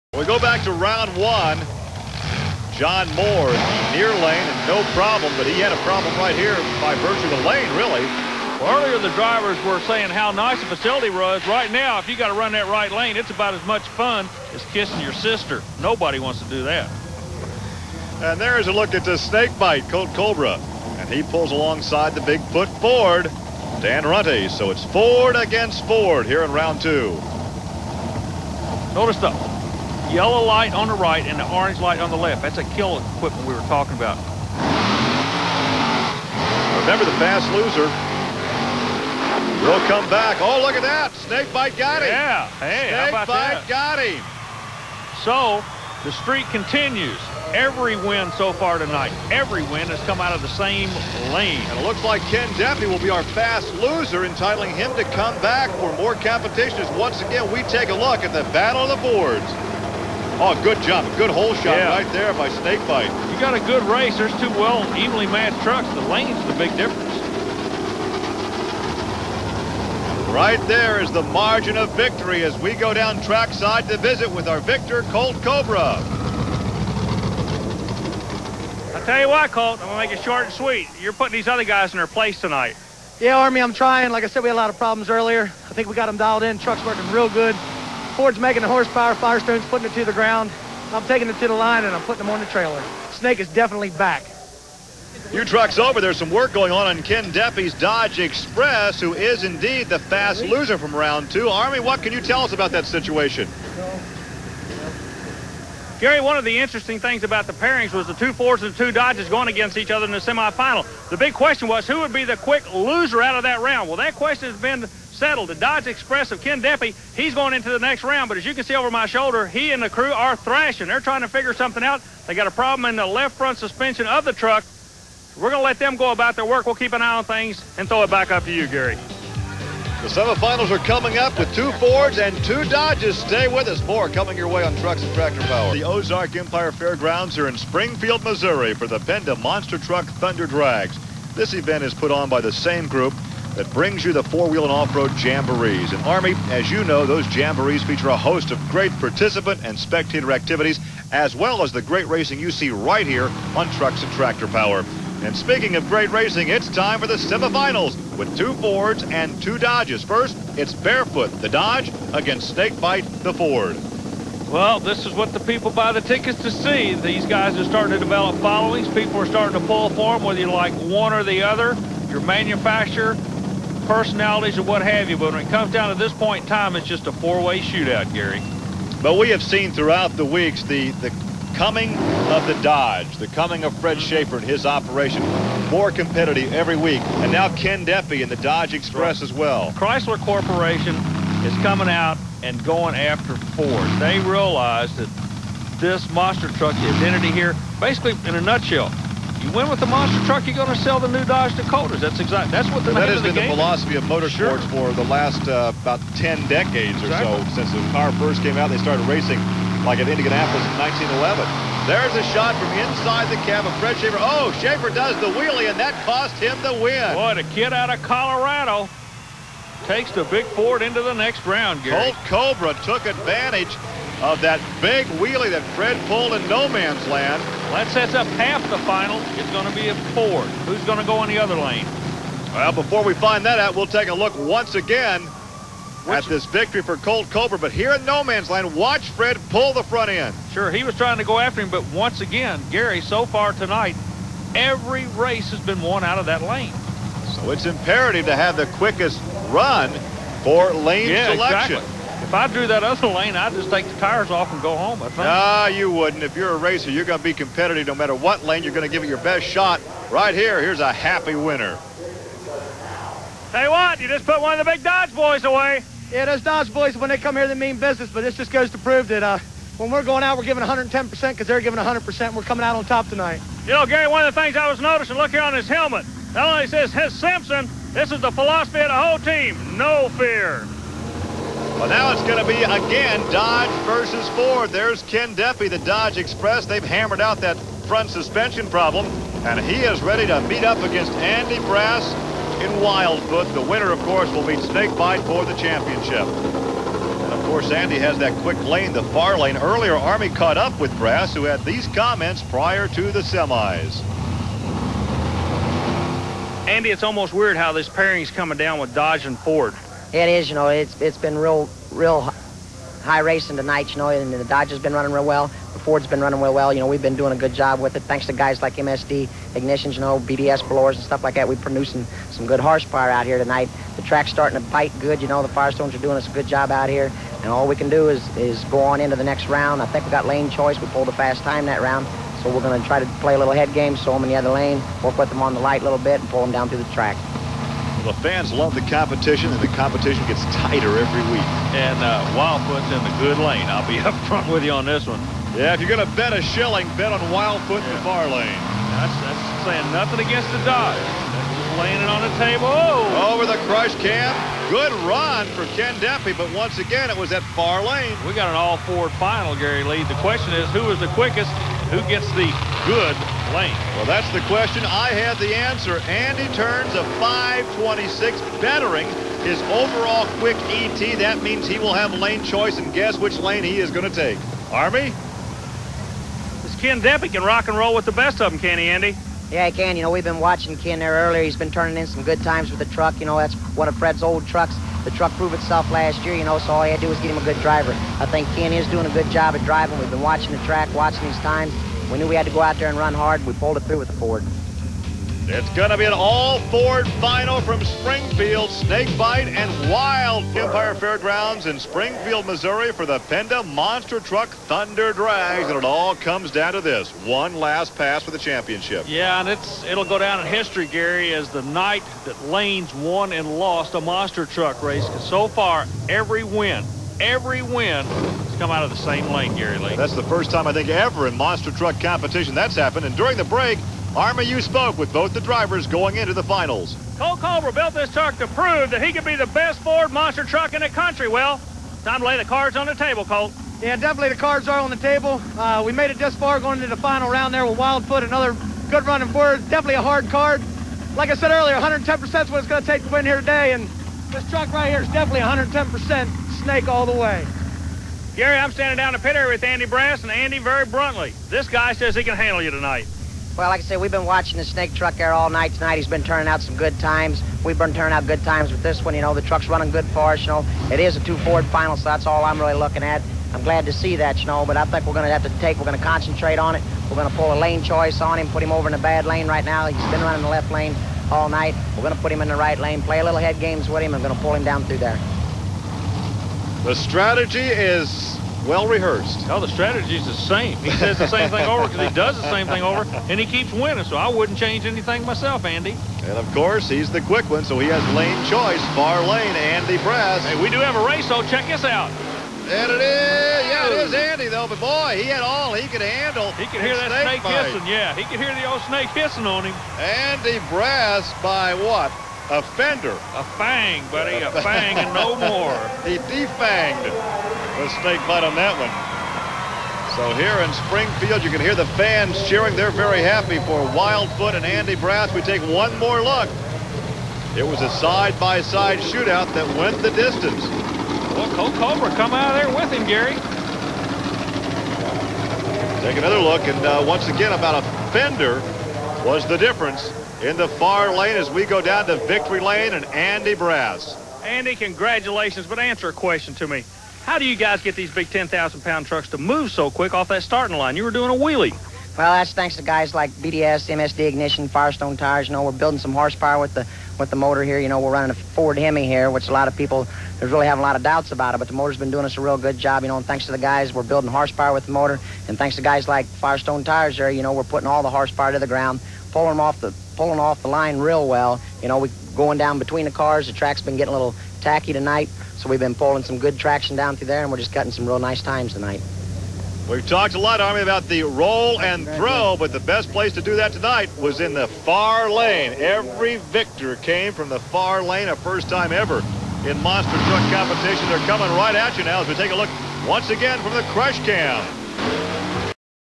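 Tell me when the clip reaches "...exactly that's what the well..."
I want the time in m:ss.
3:22.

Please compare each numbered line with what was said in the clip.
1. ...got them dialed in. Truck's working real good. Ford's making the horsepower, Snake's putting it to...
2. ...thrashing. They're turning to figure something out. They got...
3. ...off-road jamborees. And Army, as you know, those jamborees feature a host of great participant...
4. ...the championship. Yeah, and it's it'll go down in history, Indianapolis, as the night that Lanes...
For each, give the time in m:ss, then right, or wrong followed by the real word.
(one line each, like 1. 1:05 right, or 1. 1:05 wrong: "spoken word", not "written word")
1. 1:25 wrong: "Firestone", not "Snake"
2. 2:00 wrong: "trying", not "turning"
3. 2:24 right
4. 6:48 wrong: "Gary", not "Indianapolis".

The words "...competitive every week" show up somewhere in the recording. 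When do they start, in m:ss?
3:05.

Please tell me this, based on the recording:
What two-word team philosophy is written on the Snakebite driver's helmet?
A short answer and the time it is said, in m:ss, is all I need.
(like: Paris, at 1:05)
No fear, at 4:39.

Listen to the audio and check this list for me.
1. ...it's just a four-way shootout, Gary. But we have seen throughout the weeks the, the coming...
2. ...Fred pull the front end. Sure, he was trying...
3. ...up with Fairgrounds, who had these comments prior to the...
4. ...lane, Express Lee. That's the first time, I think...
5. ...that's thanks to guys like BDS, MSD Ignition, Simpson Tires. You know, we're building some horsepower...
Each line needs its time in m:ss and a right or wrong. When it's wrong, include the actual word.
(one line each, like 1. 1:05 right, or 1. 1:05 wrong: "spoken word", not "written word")
1. 2:56 right
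2. 3:59 right
3. 5:00 wrong: "Brass", not "Fairgrounds"
4. 6:59 wrong: "Gary", not "Express"
5. 9:02 wrong: "Firestone", not "Simpson".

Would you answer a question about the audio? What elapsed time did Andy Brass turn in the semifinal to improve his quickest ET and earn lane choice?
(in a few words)
5.26.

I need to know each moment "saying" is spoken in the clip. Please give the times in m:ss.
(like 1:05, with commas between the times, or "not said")
0:09, 5:49.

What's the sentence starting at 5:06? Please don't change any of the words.
Andy, it's almost weird how this pairing's coming down with Dodge and Ford.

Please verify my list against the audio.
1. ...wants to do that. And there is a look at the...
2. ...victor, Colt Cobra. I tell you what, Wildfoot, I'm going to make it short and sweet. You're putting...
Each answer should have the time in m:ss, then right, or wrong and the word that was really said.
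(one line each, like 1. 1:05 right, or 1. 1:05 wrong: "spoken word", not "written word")
1. 0:16 right
2. 1:14 wrong: "Colt", not "Wildfoot".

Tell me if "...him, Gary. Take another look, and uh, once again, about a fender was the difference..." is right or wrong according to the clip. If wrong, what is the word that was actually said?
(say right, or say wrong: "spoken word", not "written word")
right.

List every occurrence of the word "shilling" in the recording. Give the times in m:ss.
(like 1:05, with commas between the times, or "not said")
5:46.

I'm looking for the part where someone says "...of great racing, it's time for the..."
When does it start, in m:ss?
2:35.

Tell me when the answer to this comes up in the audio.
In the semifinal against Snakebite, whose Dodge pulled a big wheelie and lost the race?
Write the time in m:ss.
3:33.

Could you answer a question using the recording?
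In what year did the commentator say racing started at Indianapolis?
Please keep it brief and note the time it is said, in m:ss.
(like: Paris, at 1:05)
1911, at 3:31.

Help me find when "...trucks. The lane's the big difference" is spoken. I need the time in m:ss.
1:05.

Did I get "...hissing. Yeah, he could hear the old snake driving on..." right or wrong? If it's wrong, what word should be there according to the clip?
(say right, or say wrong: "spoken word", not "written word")
wrong: "hissing", not "driving".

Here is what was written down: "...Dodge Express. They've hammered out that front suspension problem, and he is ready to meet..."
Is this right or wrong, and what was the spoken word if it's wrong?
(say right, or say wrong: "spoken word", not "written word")
right.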